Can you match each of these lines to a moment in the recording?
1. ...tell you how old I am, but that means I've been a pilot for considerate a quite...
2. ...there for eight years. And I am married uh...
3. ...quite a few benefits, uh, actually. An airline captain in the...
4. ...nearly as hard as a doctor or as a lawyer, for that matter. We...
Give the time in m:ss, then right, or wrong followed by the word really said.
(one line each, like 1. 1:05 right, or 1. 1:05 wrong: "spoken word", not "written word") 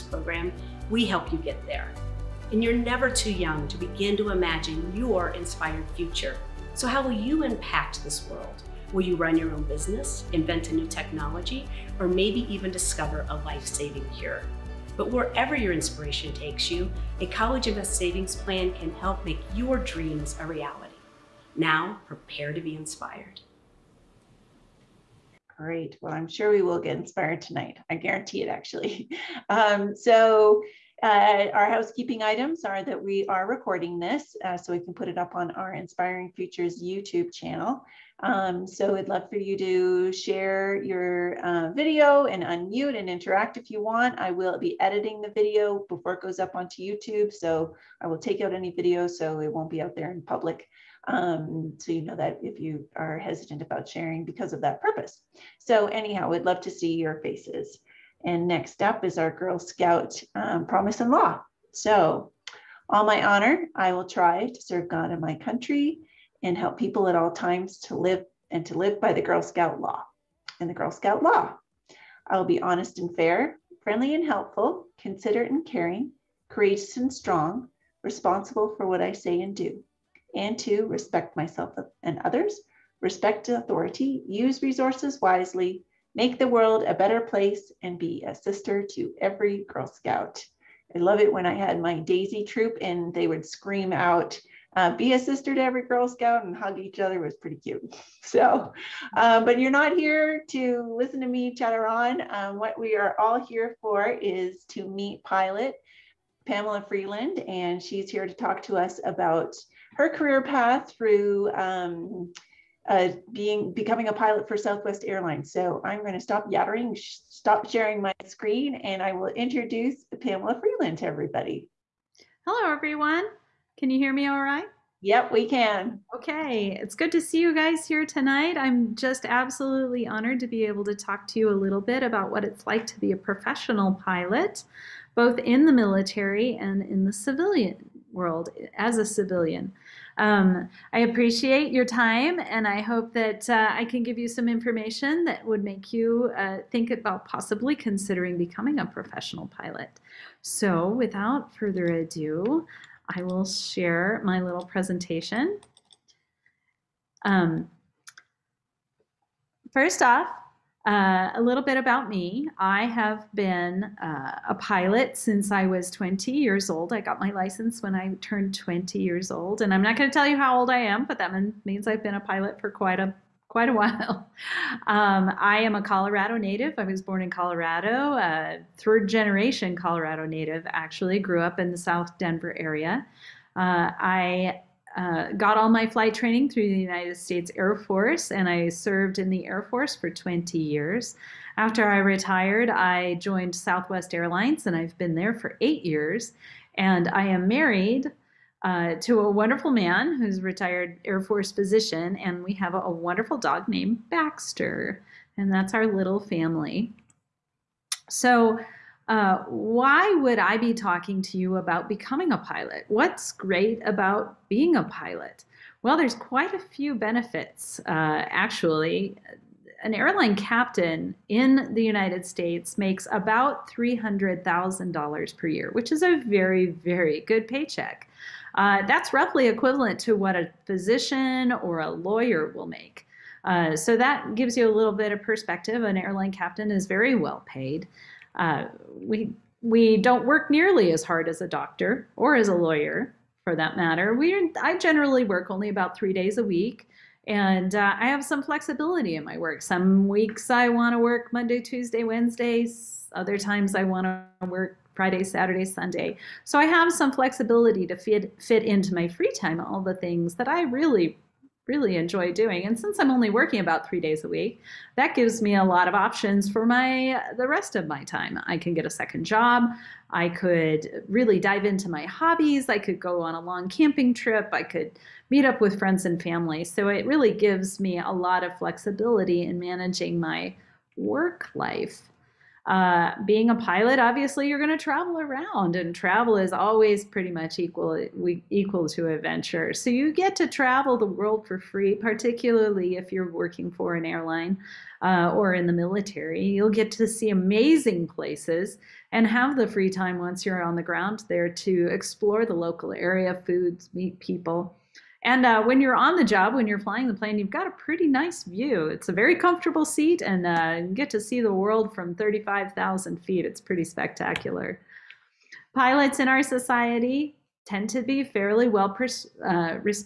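1. 2:50 wrong: "quite", not "considerate"
2. 3:15 right
3. 3:36 right
4. 4:00 right.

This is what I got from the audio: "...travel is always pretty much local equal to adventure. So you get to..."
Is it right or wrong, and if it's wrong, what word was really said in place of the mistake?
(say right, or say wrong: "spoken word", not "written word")
wrong: "equal", not "local".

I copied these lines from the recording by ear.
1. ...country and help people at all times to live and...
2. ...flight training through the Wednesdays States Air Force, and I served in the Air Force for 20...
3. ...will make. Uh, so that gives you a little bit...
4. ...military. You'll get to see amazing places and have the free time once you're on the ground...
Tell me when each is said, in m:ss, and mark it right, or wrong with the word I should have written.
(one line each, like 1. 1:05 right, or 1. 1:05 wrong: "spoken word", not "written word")
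1. 1:05 right
2. 3:05 wrong: "United", not "Wednesdays"
3. 3:52 right
4. 4:55 right.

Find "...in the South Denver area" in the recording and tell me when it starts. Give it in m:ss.
3:01.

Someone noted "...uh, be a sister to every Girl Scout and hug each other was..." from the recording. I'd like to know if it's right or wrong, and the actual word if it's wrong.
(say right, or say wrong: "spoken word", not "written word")
right.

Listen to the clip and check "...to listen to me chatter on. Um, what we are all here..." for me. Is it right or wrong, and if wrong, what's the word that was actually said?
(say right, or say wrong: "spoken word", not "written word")
right.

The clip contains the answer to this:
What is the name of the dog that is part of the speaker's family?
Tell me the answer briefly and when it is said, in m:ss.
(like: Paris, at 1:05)
Baxter, at 3:24.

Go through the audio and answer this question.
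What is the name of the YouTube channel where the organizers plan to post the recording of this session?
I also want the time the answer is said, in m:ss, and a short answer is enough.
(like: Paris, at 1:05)
Inspiring Futures, at 0:35.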